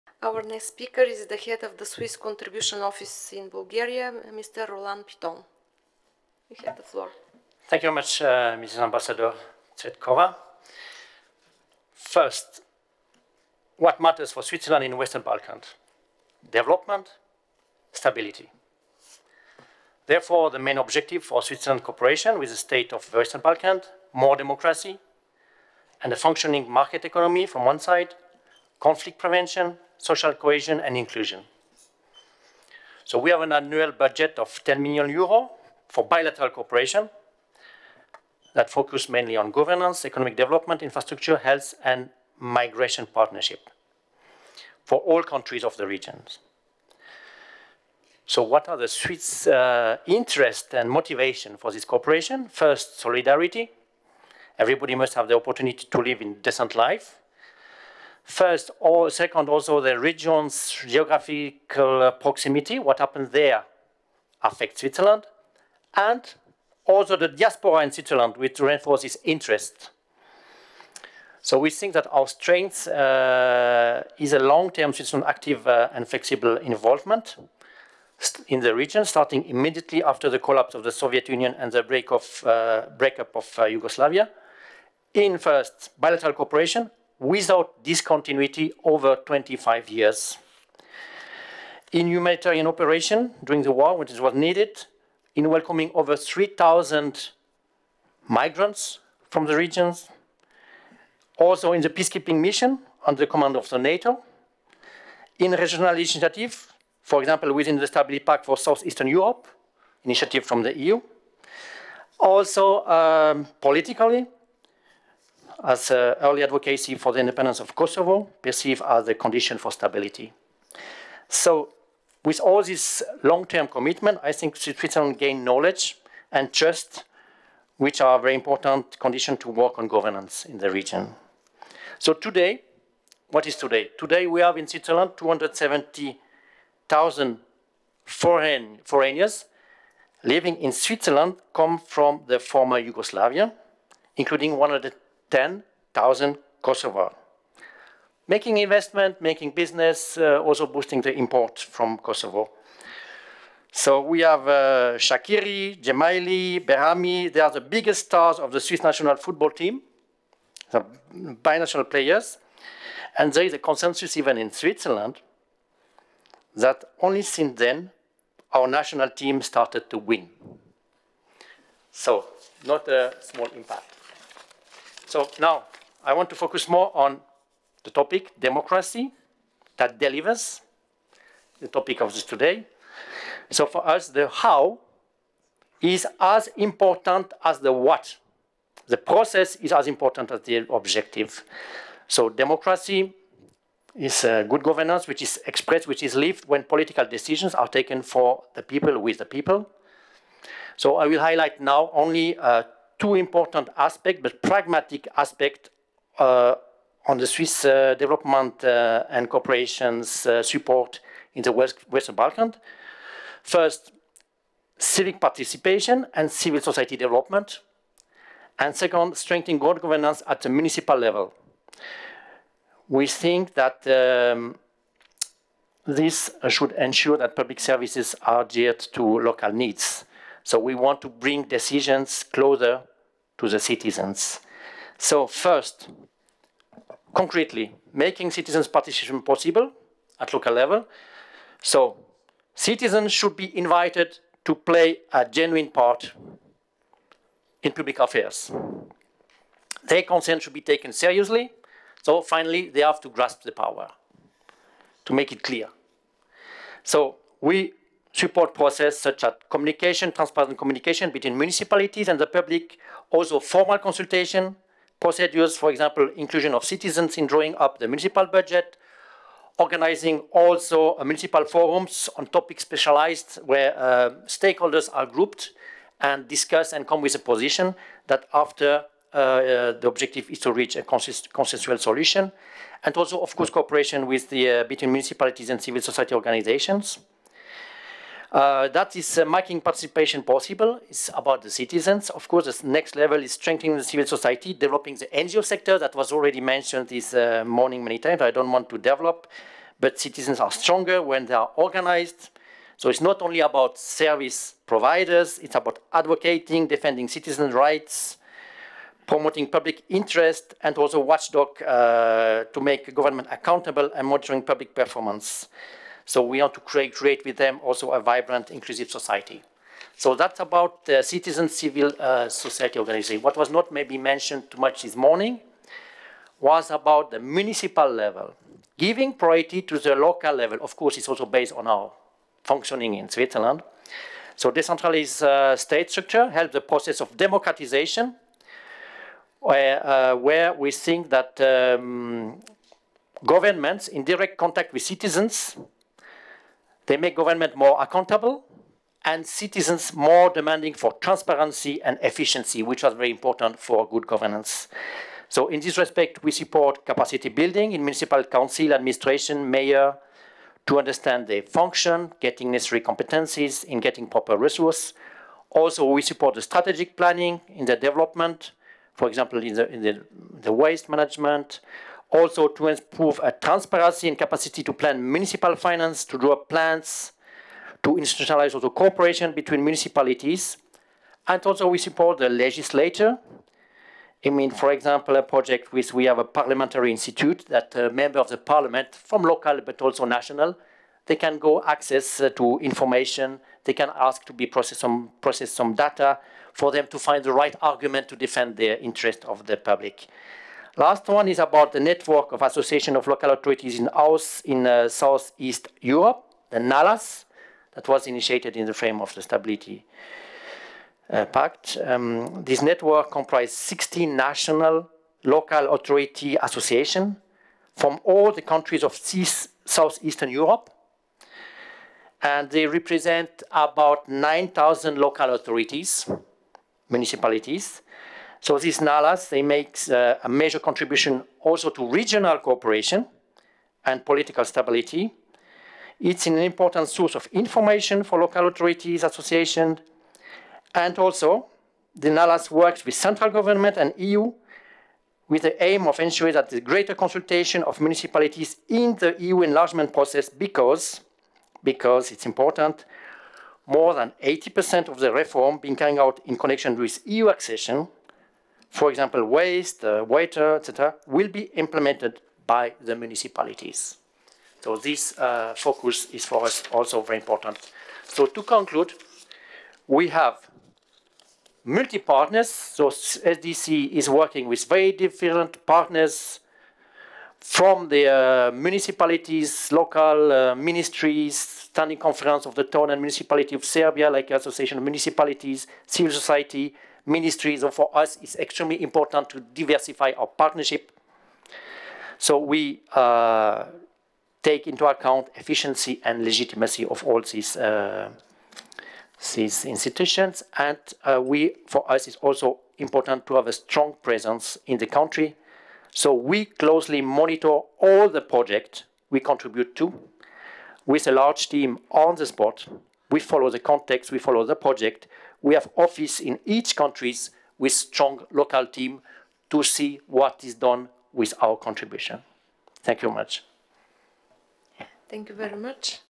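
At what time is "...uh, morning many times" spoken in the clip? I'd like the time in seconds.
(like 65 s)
297 s.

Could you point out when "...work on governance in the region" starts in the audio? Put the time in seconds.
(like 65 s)
129 s.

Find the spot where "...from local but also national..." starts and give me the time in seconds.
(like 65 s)
388 s.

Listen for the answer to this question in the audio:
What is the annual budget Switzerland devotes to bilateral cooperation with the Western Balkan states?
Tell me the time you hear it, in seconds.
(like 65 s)
34 s.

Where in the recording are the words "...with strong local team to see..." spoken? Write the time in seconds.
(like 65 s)
517 s.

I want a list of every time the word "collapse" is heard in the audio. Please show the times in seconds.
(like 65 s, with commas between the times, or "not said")
80 s.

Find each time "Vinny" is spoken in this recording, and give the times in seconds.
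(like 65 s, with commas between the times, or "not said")
not said.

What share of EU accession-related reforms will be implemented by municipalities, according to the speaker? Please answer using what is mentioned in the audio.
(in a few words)
more than 80%.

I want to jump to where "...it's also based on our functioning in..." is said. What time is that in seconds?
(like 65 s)
330 s.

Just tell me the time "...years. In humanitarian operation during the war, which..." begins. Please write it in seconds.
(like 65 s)
89 s.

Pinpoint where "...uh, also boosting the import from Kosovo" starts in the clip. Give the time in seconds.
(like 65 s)
150 s.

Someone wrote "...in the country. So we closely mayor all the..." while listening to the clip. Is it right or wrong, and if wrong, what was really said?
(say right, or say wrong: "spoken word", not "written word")
wrong: "monitor", not "mayor".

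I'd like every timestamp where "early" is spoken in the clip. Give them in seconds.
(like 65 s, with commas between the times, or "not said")
116 s.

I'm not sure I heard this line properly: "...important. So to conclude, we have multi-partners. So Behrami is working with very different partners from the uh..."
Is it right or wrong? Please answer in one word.
wrong.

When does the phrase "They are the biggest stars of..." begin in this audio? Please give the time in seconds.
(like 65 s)
157 s.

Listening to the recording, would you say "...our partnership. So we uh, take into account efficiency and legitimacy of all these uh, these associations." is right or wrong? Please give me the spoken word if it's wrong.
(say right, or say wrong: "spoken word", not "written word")
wrong: "institutions", not "associations".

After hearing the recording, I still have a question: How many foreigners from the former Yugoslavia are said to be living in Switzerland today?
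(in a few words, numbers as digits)
270,000.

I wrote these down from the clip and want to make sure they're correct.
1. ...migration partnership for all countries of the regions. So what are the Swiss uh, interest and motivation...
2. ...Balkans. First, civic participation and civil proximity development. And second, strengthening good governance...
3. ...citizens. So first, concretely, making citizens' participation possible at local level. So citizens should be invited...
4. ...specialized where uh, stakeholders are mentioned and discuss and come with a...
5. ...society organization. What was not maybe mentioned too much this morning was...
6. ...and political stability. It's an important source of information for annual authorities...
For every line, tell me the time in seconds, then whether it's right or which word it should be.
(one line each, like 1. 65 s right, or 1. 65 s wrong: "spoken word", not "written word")
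1. 42 s right
2. 212 s wrong: "society", not "proximity"
3. 233 s right
4. 272 s wrong: "grouped", not "mentioned"
5. 322 s right
6. 433 s wrong: "local", not "annual".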